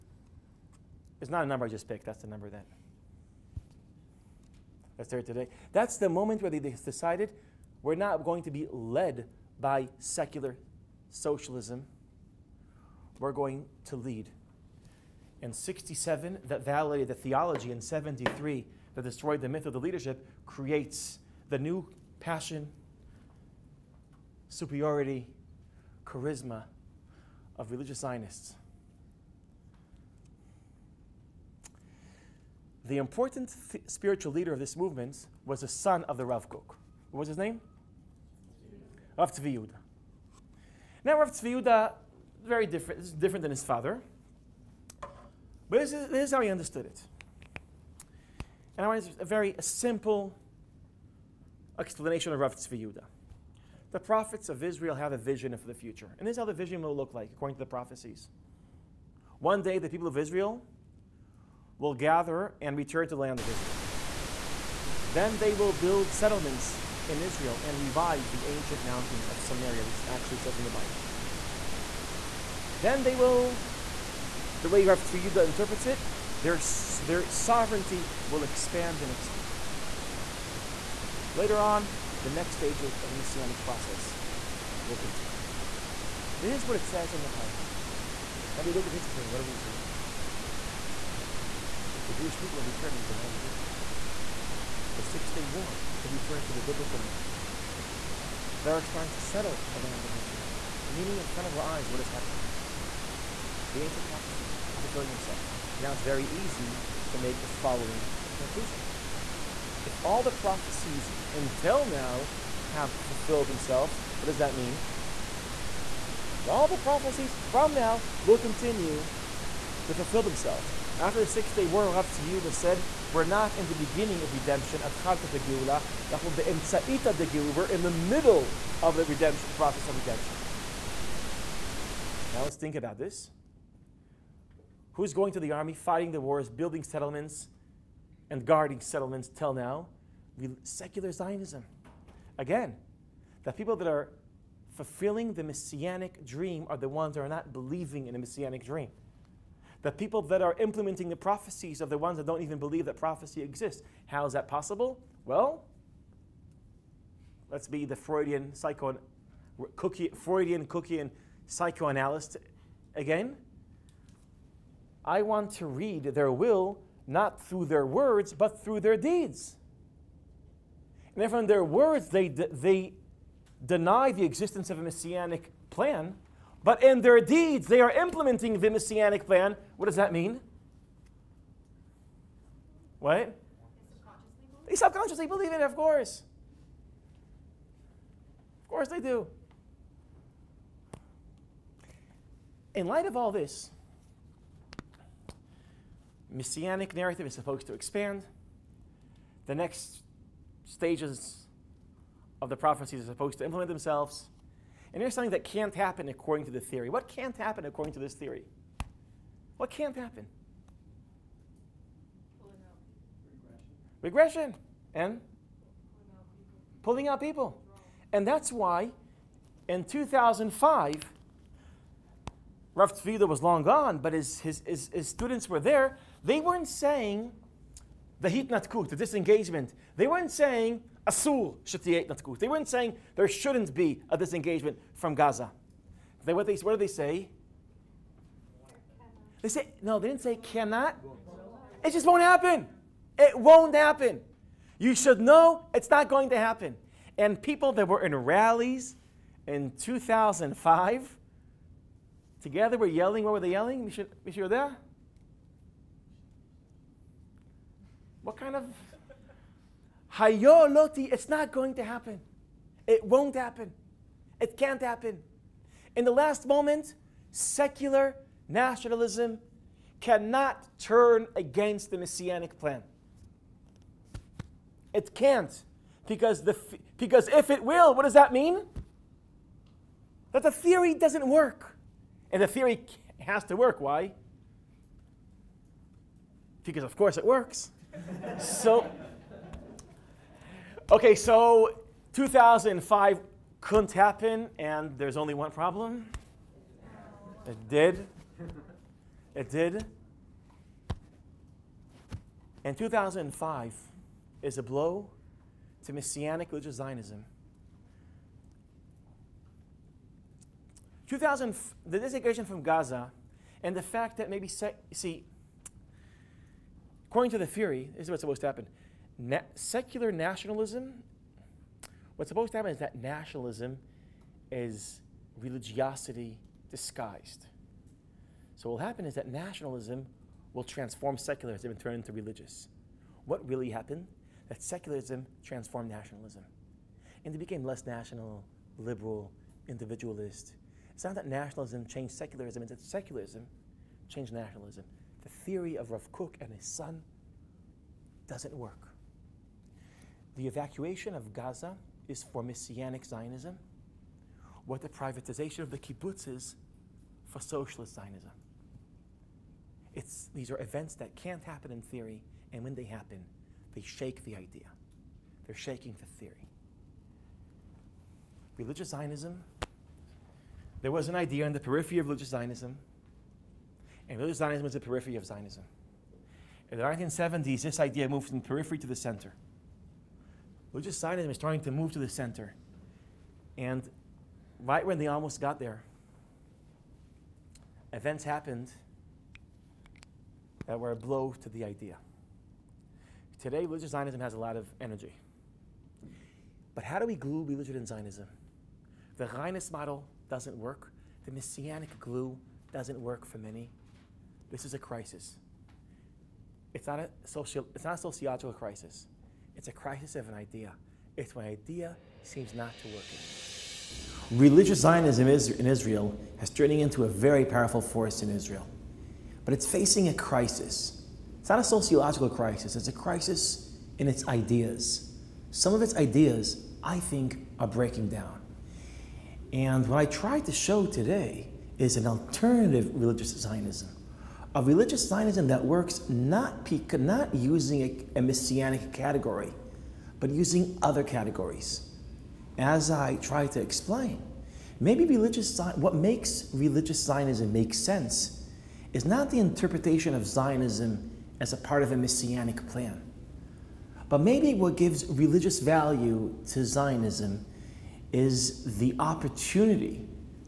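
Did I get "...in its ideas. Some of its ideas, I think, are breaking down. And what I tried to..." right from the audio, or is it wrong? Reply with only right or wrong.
right.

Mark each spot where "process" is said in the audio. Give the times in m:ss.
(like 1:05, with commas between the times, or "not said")
1:23, 2:09.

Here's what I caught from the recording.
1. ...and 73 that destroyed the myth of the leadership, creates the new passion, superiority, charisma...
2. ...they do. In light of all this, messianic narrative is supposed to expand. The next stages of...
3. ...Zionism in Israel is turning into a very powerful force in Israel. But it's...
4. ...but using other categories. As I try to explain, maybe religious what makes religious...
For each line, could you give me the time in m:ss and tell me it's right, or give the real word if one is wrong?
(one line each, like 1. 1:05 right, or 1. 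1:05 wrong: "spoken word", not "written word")
1. 0:17 right
2. 3:08 right
3. 6:54 right
4. 7:20 right.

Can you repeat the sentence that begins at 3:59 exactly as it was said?
They say, no, they didn't say cannot.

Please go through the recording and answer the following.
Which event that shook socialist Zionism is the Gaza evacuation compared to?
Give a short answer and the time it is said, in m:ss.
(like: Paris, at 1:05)
Privatization of the kibbutz, at 5:54.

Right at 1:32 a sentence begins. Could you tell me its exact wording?
The Jewish people are returning to the land of Israel.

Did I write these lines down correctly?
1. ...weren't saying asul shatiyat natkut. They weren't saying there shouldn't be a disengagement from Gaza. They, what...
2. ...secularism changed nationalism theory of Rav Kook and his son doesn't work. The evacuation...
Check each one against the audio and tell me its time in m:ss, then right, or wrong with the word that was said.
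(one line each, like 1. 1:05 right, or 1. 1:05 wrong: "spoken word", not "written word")
1. 3:50 right
2. 5:42 right.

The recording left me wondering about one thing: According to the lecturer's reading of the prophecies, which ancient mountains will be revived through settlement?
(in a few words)
Mountains of Samaria.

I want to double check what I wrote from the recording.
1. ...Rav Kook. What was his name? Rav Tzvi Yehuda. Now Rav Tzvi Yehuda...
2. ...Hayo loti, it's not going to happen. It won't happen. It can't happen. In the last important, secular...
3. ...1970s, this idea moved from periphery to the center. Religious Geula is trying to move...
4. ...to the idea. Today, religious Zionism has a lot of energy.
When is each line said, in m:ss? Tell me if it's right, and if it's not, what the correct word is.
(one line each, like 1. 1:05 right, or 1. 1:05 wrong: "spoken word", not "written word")
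1. 0:36 right
2. 4:20 wrong: "moment", not "important"
3. 6:16 wrong: "Zionism", not "Geula"
4. 6:31 right.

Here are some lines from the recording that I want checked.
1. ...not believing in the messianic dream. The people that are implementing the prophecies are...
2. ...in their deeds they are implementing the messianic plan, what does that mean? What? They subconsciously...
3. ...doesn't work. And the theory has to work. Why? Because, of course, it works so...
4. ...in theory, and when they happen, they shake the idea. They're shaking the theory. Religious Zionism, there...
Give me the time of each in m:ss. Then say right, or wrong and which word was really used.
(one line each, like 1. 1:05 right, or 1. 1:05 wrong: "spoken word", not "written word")
1. 2:27 right
2. 2:56 right
3. 4:40 right
4. 6:01 right.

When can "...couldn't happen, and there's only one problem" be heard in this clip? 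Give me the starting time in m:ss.
4:53.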